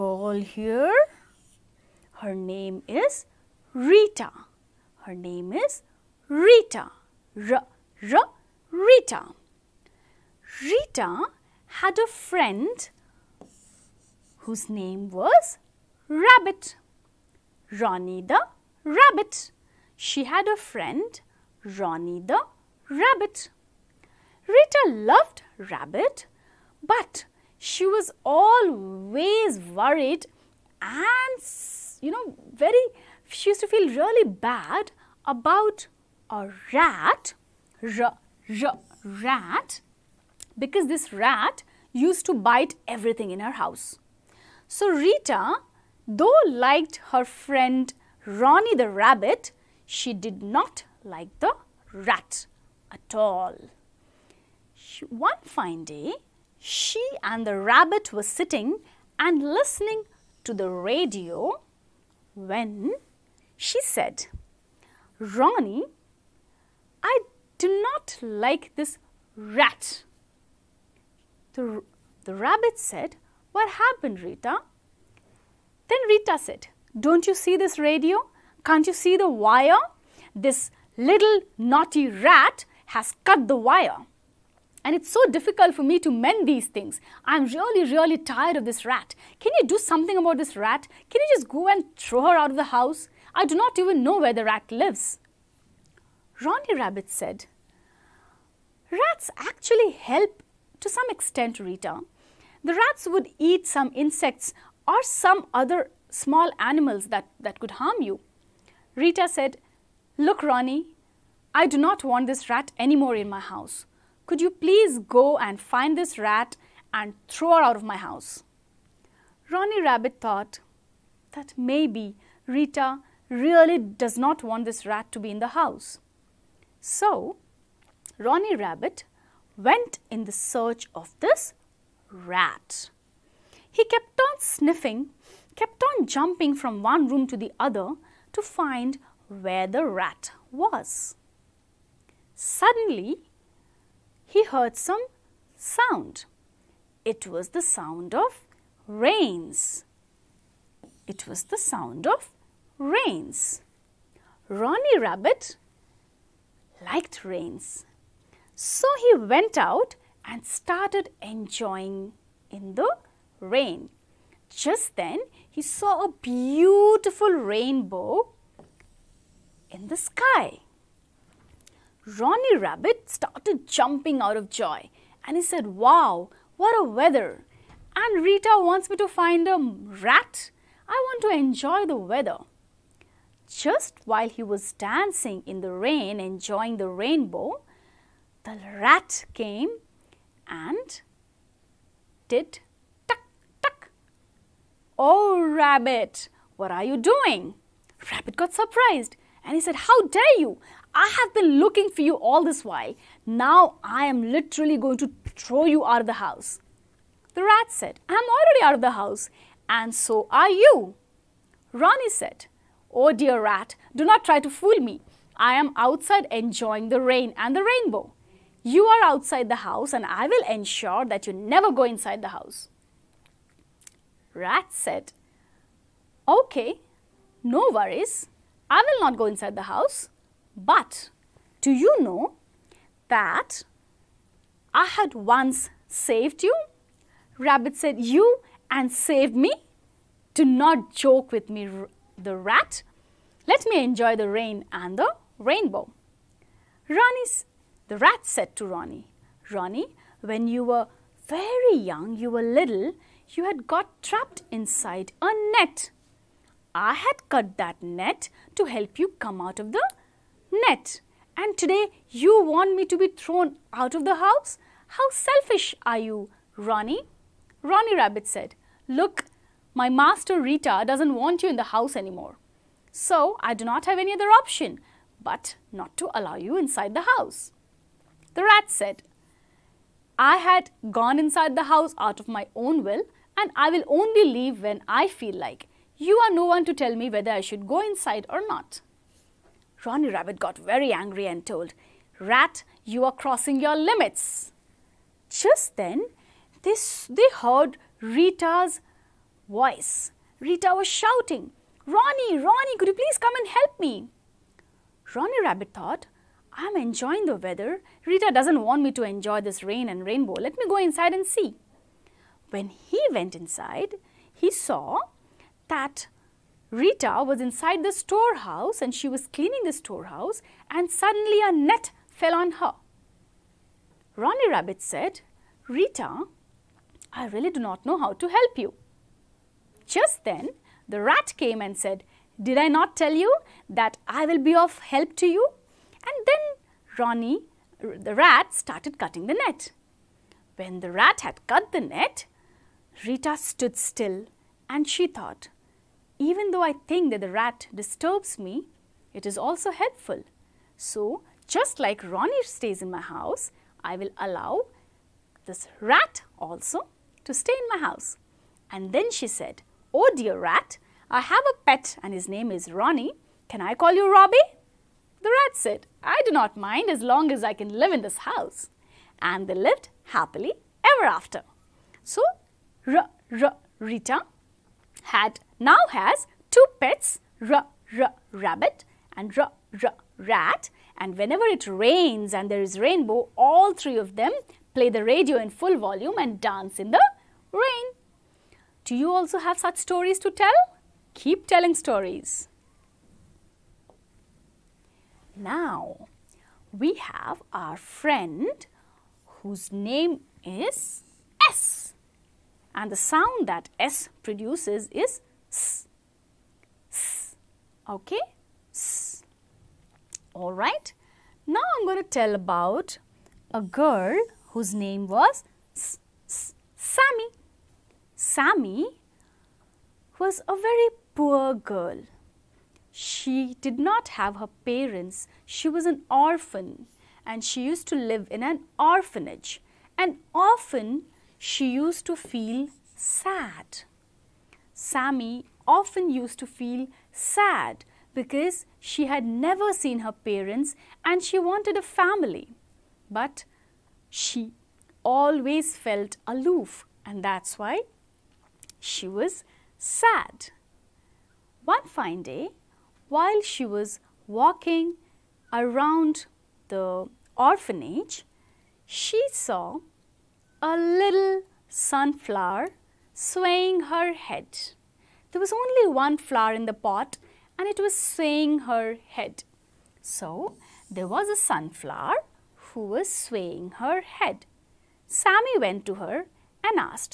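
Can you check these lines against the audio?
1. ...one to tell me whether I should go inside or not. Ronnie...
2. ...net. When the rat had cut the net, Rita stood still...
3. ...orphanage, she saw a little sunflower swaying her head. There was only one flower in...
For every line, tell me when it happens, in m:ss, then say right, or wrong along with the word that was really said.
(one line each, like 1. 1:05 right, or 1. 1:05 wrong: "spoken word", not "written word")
1. 4:46 right
2. 5:39 right
3. 7:37 right.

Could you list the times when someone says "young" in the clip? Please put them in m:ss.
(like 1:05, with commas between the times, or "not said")
4:11.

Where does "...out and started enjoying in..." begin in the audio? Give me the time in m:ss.
2:39.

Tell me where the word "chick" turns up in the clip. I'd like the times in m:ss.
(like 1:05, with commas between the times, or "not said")
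not said.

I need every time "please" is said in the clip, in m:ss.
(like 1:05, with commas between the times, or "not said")
1:54, 5:02.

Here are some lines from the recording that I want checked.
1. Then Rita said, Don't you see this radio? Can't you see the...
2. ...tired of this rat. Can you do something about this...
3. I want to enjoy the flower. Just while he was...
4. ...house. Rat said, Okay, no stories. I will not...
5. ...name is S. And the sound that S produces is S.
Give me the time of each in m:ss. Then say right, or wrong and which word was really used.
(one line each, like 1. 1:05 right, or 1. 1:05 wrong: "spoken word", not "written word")
1. 1:15 right
2. 1:28 right
3. 3:00 wrong: "weather", not "flower"
4. 3:42 wrong: "worries", not "stories"
5. 6:39 right.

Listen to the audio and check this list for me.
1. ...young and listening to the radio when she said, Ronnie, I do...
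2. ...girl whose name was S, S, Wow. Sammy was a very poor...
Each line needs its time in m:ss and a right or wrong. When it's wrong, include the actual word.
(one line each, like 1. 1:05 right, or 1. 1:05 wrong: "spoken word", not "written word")
1. 0:58 wrong: "sitting", not "young"
2. 6:53 wrong: "Sammy", not "Wow".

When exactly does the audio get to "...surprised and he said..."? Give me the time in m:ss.
3:18.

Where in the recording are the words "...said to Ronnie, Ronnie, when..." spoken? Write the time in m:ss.
4:08.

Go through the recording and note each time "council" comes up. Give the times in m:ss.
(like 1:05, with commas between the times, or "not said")
not said.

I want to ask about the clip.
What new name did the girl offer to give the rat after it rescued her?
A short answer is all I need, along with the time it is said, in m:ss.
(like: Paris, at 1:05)
Robbie, at 6:03.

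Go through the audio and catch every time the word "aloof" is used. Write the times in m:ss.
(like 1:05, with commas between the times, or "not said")
7:26.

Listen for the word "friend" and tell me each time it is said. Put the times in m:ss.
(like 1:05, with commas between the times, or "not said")
0:12, 0:20, 0:47, 6:37.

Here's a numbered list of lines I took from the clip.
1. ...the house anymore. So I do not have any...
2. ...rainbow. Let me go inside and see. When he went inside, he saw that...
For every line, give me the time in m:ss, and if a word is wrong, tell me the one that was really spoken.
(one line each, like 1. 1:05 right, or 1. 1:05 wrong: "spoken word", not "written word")
1. 4:31 right
2. 5:10 right.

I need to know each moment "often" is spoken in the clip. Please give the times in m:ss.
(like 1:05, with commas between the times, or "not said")
7:10, 7:15.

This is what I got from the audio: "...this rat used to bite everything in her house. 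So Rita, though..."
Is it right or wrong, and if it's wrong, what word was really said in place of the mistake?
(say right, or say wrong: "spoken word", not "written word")
right.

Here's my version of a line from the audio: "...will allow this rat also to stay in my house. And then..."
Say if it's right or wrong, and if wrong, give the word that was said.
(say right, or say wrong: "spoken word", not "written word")
right.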